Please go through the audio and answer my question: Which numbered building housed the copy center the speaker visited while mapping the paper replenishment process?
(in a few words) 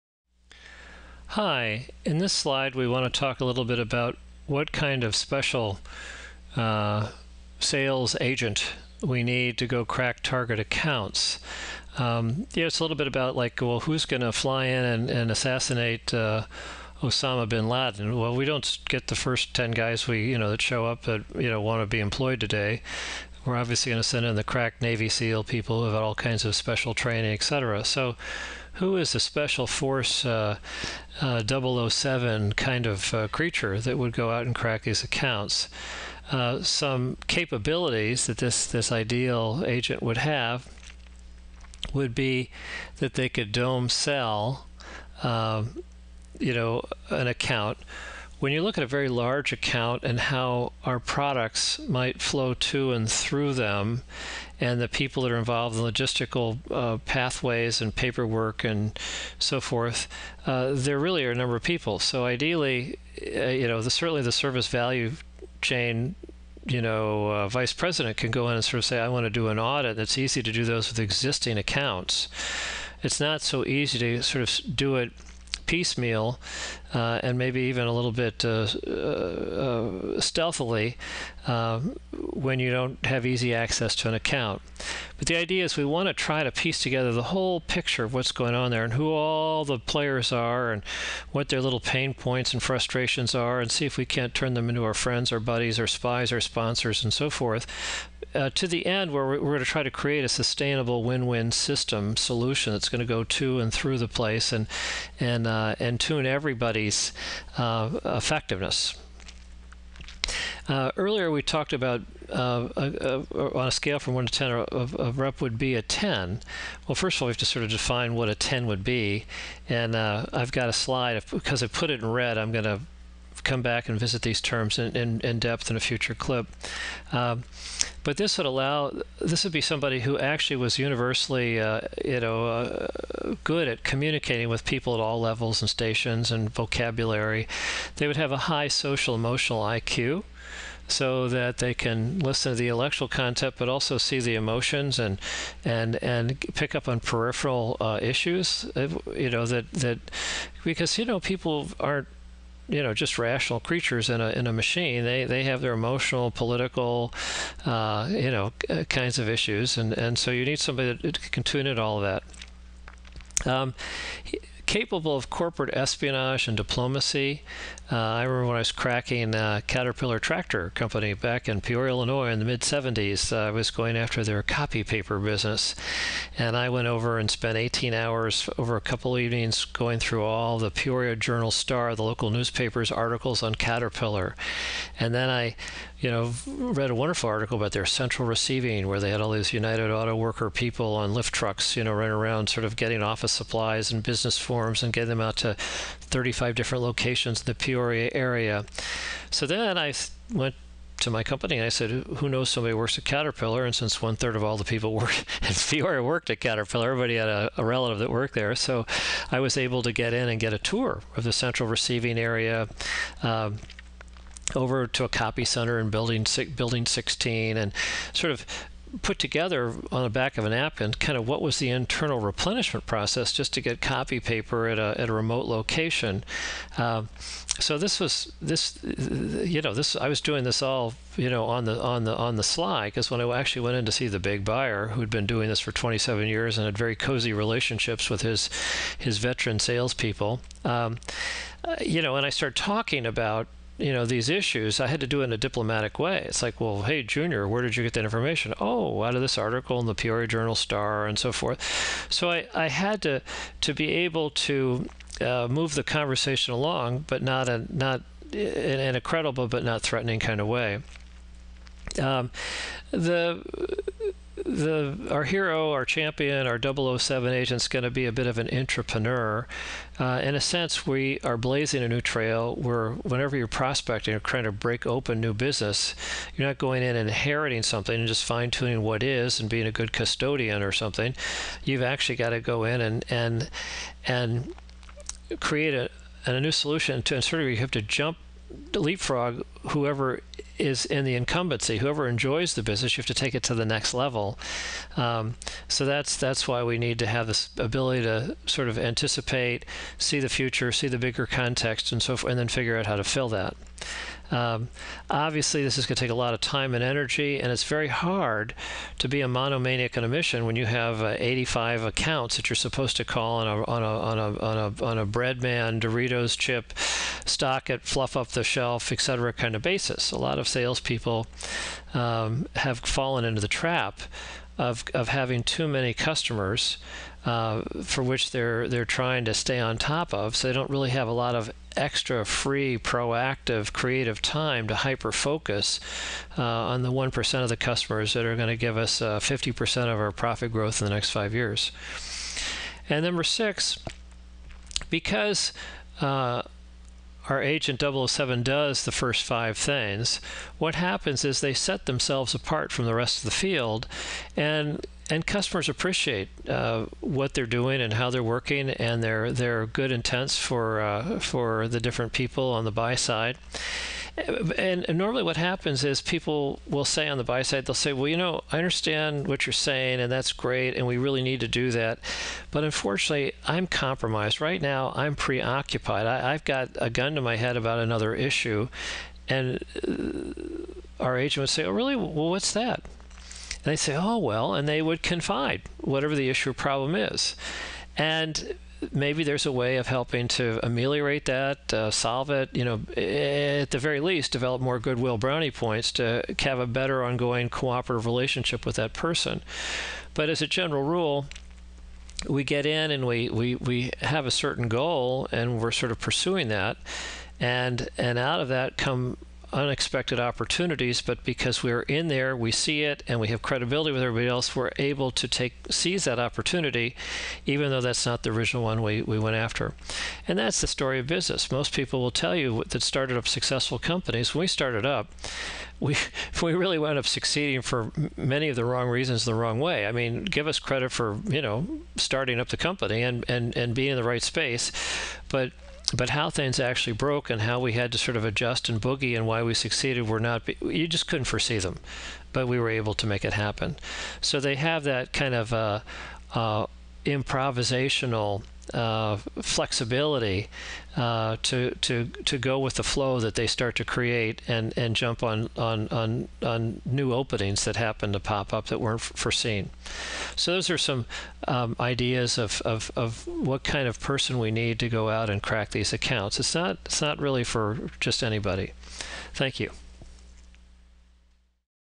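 Building 16.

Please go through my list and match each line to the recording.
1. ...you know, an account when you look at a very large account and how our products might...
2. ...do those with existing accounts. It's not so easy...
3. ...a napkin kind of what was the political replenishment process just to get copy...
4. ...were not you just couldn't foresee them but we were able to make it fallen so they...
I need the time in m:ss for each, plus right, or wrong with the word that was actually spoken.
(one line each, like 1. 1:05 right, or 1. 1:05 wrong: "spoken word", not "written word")
1. 0:46 right
2. 1:10 right
3. 3:40 wrong: "internal", not "political"
4. 7:20 wrong: "happen", not "fallen".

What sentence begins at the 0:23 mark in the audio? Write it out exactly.
We're obviously going to send in the crack Navy SEAL people who have all kinds of special training, etc.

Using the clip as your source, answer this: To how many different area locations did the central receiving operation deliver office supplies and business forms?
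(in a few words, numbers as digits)
35.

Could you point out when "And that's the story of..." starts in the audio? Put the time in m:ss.
7:00.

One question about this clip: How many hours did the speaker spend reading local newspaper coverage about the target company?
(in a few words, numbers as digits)
18.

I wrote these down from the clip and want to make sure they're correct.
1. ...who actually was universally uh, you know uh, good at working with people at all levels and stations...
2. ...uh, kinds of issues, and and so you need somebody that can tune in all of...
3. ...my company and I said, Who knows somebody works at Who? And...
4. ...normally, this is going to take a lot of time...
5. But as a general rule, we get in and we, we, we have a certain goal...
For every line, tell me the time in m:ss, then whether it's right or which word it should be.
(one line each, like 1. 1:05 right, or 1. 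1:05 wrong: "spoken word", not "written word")
1. 2:10 wrong: "communicating", not "working"
2. 2:38 right
3. 3:21 wrong: "Caterpillar", not "Who"
4. 5:05 wrong: "obviously", not "normally"
5. 6:40 right.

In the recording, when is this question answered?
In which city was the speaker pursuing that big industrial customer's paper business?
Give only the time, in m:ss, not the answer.
2:51.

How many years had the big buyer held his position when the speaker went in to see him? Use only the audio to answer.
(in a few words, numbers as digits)
27.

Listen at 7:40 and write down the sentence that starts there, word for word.
So those are some um, ideas of, of of what kind of person we need to go out and crack these accounts.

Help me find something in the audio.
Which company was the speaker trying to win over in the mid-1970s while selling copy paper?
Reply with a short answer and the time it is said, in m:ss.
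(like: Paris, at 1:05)
Caterpillar Tractor Company, at 2:49.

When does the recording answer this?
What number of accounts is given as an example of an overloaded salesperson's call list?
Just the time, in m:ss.
5:11.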